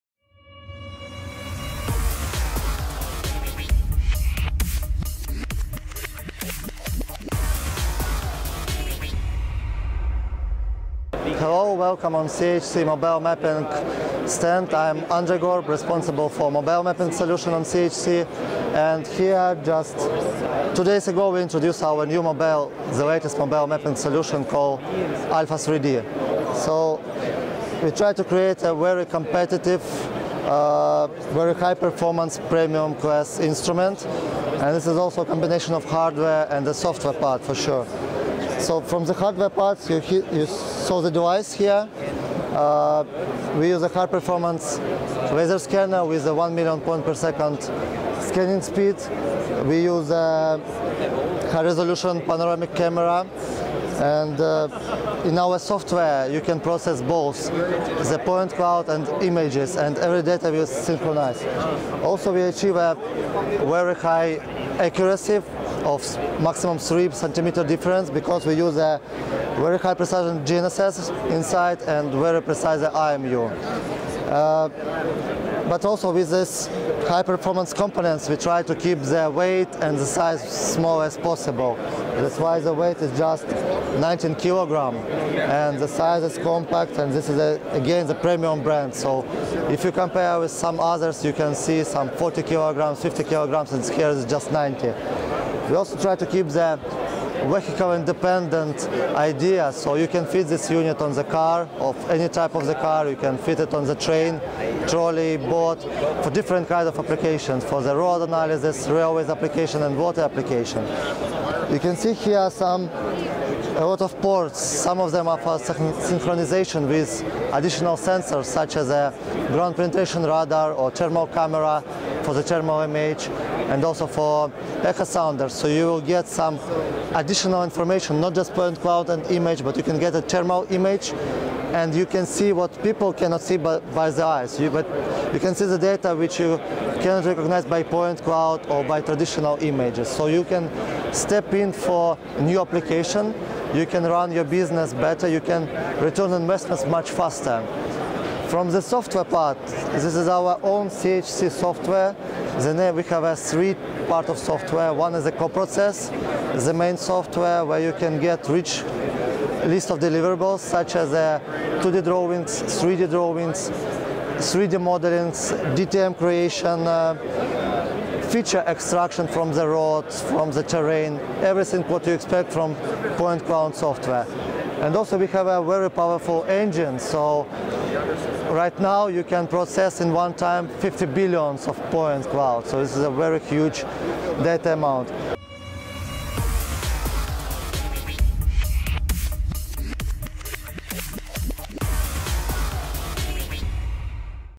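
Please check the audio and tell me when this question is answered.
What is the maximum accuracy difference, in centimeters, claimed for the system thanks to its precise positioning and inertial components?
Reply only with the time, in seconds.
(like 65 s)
66 s.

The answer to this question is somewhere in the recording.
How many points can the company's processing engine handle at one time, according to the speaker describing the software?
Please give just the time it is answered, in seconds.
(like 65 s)
180 s.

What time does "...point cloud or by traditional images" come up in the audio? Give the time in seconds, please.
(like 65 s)
137 s.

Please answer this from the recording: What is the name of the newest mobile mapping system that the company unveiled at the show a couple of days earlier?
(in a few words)
Alpha 3D.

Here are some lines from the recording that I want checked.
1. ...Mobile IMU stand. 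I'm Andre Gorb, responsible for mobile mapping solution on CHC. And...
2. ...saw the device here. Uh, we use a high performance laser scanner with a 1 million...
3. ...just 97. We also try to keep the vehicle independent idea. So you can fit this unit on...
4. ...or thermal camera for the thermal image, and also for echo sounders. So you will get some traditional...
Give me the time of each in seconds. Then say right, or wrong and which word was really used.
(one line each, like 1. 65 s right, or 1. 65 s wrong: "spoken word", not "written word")
1. 12 s wrong: "Mapping", not "IMU"
2. 40 s right
3. 94 s wrong: "90", not "97"
4. 120 s wrong: "additional", not "traditional".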